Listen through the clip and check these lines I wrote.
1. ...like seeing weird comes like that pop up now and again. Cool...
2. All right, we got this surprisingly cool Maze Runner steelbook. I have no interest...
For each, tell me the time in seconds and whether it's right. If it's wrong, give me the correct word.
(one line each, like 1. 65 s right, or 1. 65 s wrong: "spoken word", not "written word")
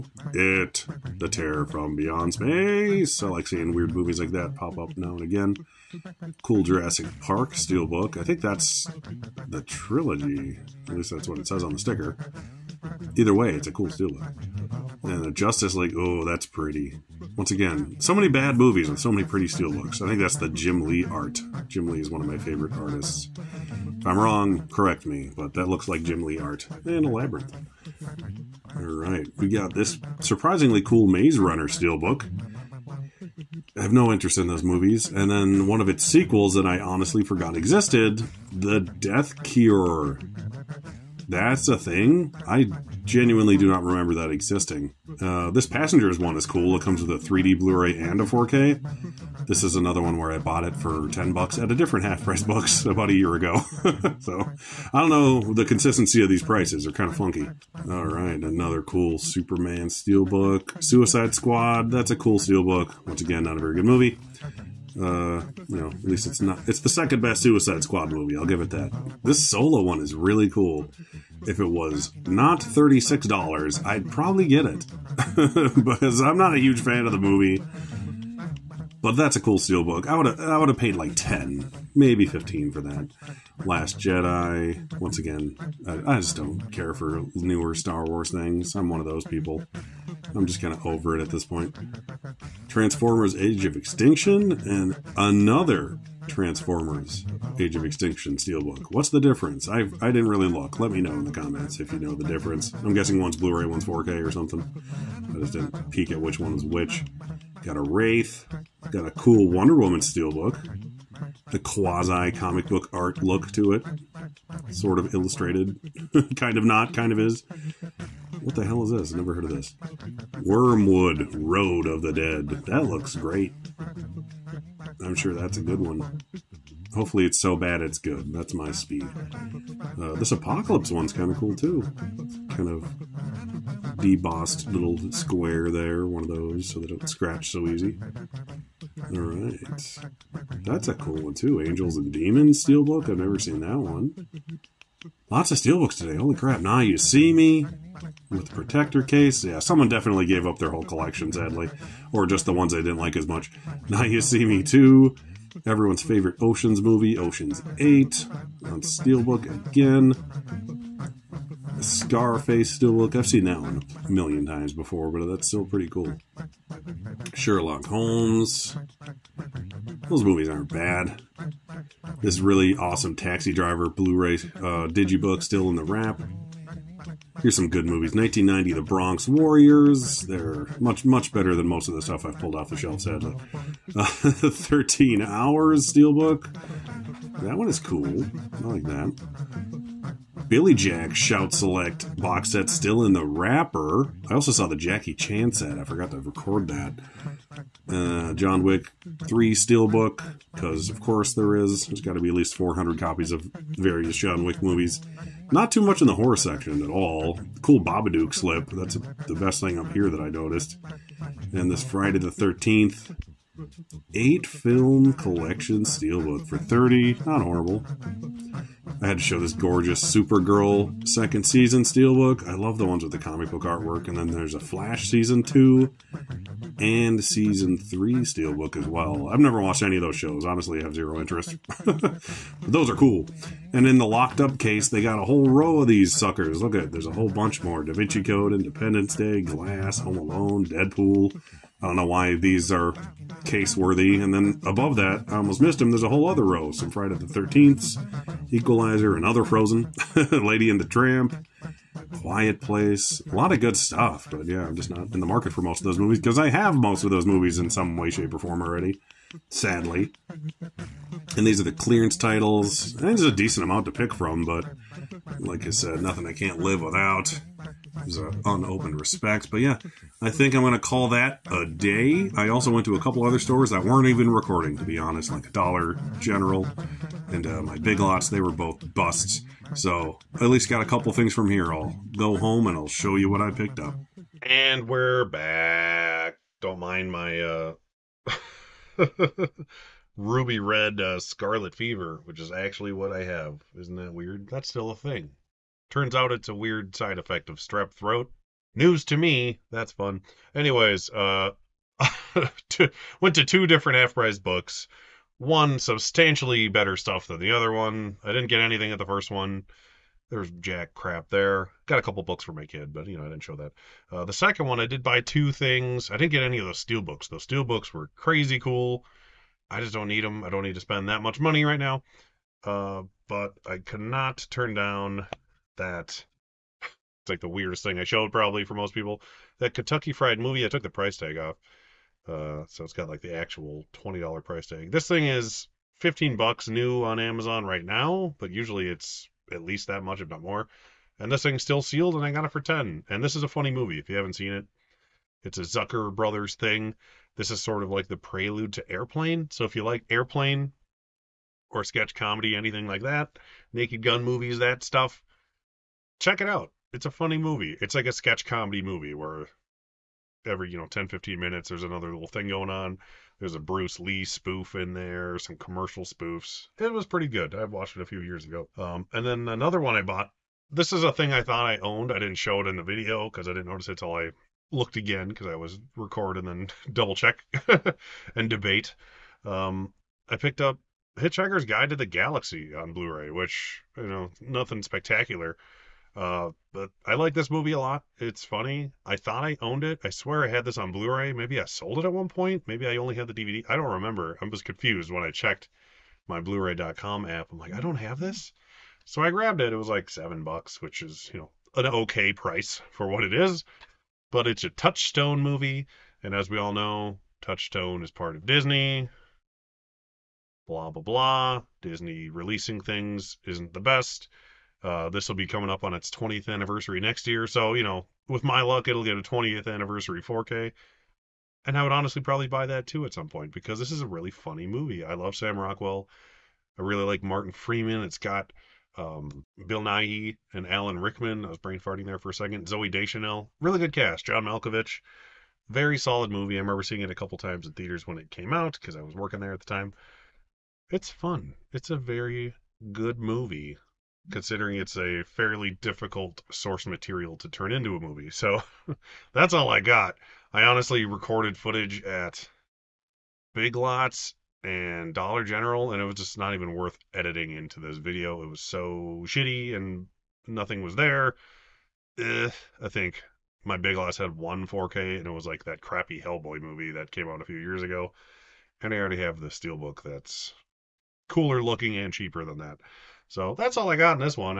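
1. 3 s wrong: "movies", not "comes"
2. 28 s right.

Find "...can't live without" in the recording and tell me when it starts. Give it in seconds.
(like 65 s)
266 s.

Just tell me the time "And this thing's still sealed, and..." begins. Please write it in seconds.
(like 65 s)
341 s.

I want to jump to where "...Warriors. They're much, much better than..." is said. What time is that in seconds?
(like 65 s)
179 s.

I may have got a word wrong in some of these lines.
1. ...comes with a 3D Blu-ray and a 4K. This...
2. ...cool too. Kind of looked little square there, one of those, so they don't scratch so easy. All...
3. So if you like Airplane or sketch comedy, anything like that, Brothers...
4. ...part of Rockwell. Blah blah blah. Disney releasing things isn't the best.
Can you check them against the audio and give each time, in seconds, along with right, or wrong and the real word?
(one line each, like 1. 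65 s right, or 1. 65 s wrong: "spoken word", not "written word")
1. 46 s right
2. 131 s wrong: "debossed", not "looked"
3. 349 s wrong: "Naked", not "Brothers"
4. 408 s wrong: "Disney", not "Rockwell".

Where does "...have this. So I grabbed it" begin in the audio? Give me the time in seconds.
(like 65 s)
397 s.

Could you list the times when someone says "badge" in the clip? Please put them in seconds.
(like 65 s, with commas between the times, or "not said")
not said.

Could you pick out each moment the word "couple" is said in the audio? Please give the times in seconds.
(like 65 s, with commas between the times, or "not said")
272 s, 280 s, 312 s, 437 s.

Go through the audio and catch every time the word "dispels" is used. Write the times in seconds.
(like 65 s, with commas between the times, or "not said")
not said.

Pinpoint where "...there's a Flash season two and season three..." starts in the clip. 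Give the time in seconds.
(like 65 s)
224 s.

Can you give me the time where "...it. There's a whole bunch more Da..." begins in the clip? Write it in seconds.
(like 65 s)
236 s.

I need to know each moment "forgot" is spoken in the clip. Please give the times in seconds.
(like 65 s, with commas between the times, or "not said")
37 s, 195 s.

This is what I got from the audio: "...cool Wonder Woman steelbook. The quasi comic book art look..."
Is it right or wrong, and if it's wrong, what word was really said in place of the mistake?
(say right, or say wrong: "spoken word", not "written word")
right.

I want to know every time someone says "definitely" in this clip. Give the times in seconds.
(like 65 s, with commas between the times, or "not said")
149 s.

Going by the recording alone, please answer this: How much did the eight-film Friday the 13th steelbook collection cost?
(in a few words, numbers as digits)
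$30.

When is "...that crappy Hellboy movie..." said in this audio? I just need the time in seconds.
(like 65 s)
465 s.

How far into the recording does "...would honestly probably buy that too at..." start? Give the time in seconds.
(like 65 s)
421 s.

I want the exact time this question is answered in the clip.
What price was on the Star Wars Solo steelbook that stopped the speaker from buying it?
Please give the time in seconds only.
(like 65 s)
72 s.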